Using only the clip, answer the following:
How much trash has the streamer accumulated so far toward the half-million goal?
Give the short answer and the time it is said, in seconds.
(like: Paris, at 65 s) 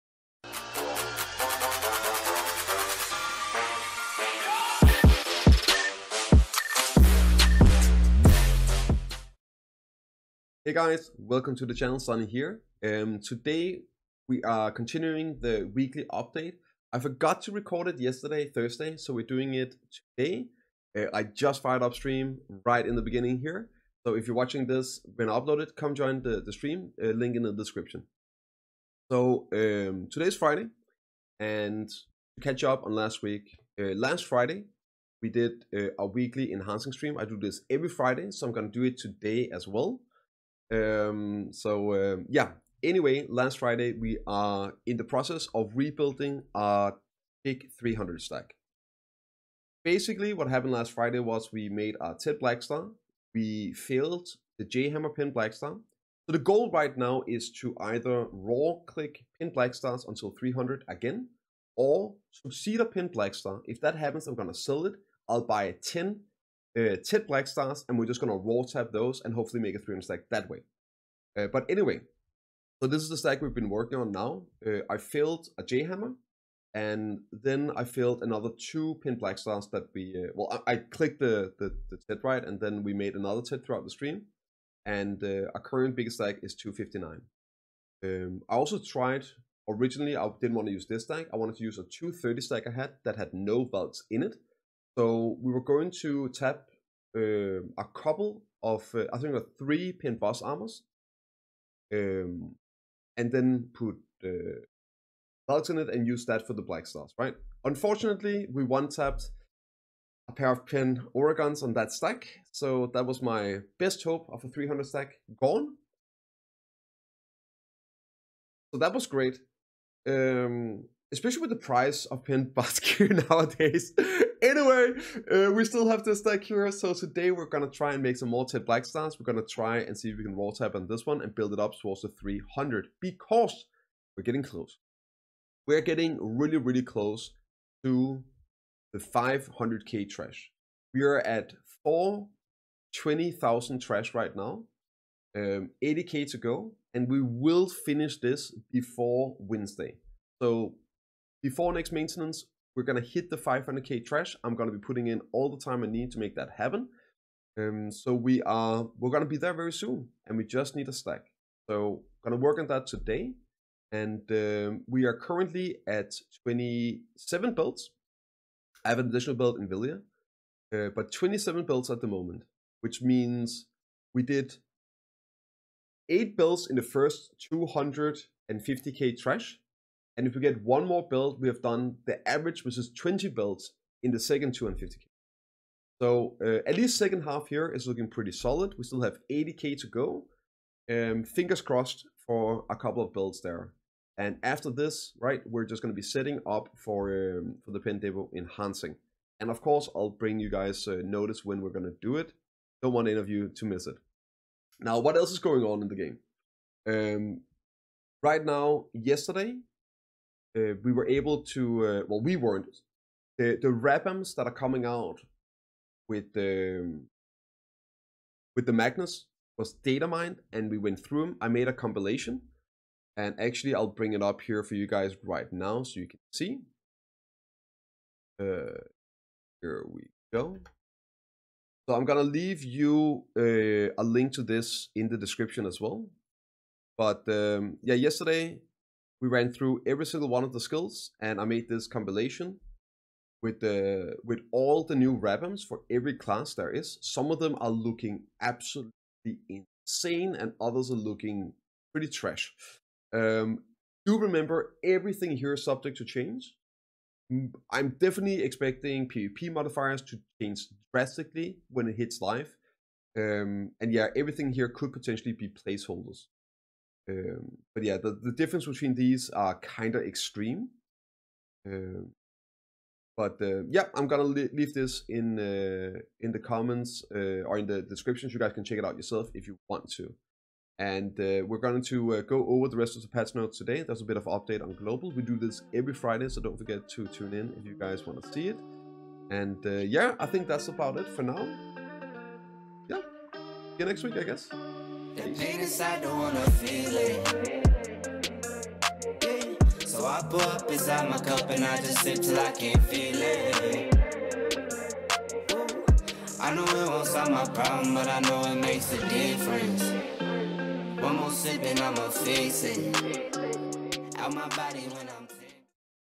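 420,000, at 141 s.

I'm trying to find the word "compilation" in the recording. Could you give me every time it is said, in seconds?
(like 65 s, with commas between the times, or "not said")
221 s, 241 s.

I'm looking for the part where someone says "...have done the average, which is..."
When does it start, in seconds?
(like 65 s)
181 s.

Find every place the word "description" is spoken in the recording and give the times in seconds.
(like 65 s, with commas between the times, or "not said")
27 s, 235 s, 277 s.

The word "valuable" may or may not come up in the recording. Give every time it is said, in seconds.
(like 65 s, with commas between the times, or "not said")
not said.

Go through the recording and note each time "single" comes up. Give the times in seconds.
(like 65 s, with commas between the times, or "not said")
240 s.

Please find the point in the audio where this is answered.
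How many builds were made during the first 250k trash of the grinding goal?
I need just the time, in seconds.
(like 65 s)
176 s.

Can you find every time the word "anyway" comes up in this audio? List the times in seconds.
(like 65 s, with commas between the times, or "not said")
42 s, 71 s, 124 s.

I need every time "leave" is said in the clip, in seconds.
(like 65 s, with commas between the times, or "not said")
232 s, 274 s.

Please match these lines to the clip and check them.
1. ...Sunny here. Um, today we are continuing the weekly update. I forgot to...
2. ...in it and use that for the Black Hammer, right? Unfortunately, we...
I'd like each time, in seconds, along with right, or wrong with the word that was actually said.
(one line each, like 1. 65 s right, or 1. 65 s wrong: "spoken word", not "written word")
1. 11 s right
2. 105 s wrong: "Stars", not "Hammer".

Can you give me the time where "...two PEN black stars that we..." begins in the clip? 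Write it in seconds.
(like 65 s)
78 s.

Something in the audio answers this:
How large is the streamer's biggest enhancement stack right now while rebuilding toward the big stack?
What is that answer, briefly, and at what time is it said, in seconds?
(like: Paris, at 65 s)
259, at 86 s.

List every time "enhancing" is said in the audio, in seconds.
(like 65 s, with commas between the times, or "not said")
36 s, 198 s.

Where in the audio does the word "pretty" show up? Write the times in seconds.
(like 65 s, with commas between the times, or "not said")
188 s, 251 s.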